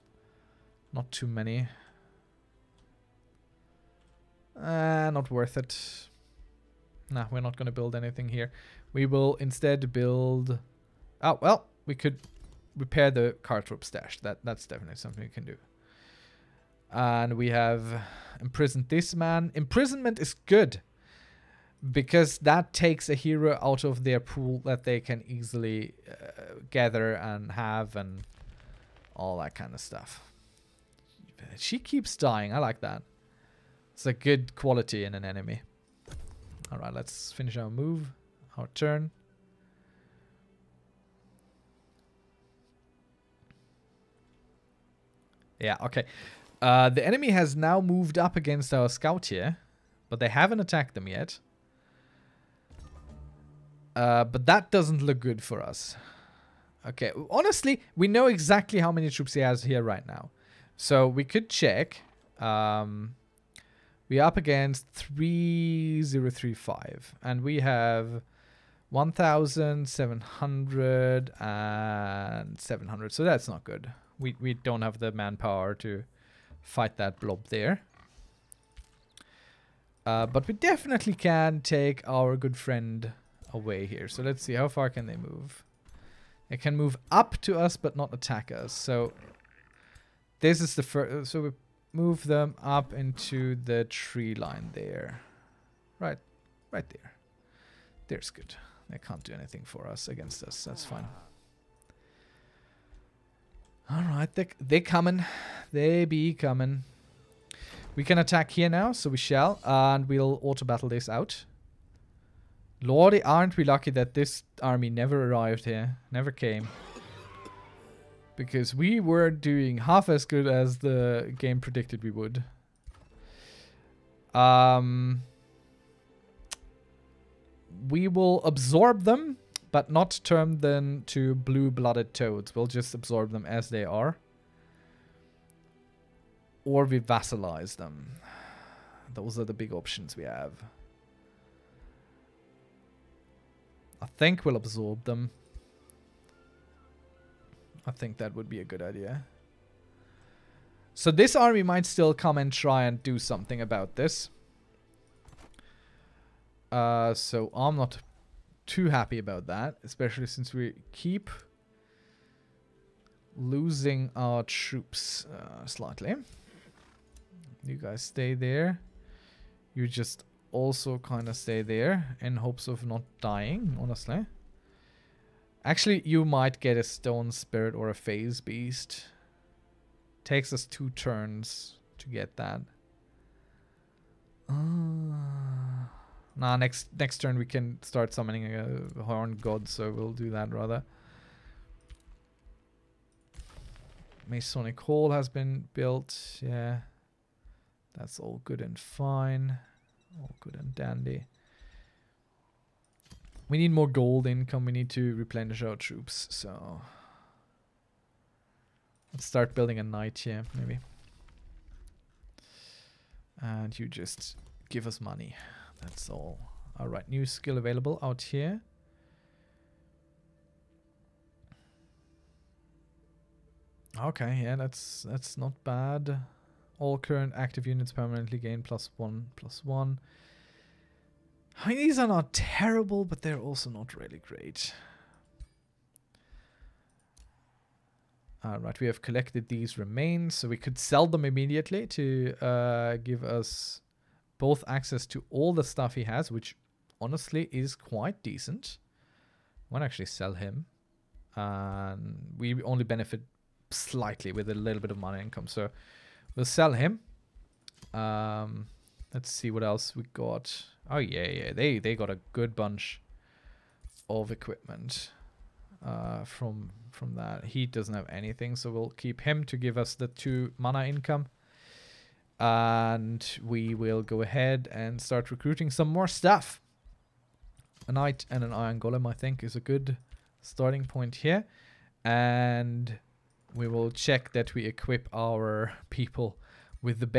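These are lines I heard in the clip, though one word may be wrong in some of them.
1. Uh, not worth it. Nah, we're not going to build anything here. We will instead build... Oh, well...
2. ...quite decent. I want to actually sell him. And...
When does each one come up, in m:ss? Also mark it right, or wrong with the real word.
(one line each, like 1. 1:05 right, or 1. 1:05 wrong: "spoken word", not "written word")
1. 0:04 right
2. 4:07 right.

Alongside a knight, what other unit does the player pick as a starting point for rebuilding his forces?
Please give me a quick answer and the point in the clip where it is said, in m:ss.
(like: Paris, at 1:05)
iron golem, at 4:38.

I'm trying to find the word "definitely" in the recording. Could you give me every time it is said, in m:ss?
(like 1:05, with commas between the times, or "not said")
0:14, 1:20.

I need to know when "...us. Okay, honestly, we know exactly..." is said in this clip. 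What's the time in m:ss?
0:55.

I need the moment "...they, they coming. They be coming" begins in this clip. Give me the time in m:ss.
1:44.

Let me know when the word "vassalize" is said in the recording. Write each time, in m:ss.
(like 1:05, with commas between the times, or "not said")
2:17.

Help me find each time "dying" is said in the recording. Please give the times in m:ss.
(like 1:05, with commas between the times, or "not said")
0:32, 2:53.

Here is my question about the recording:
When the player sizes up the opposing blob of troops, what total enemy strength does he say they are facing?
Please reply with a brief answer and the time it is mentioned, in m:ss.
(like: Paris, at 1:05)
3035, at 1:04.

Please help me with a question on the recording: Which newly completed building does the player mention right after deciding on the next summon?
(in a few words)
Masonic Hall.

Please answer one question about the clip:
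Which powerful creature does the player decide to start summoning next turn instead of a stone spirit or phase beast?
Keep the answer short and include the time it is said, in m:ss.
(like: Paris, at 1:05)
horn god, at 3:09.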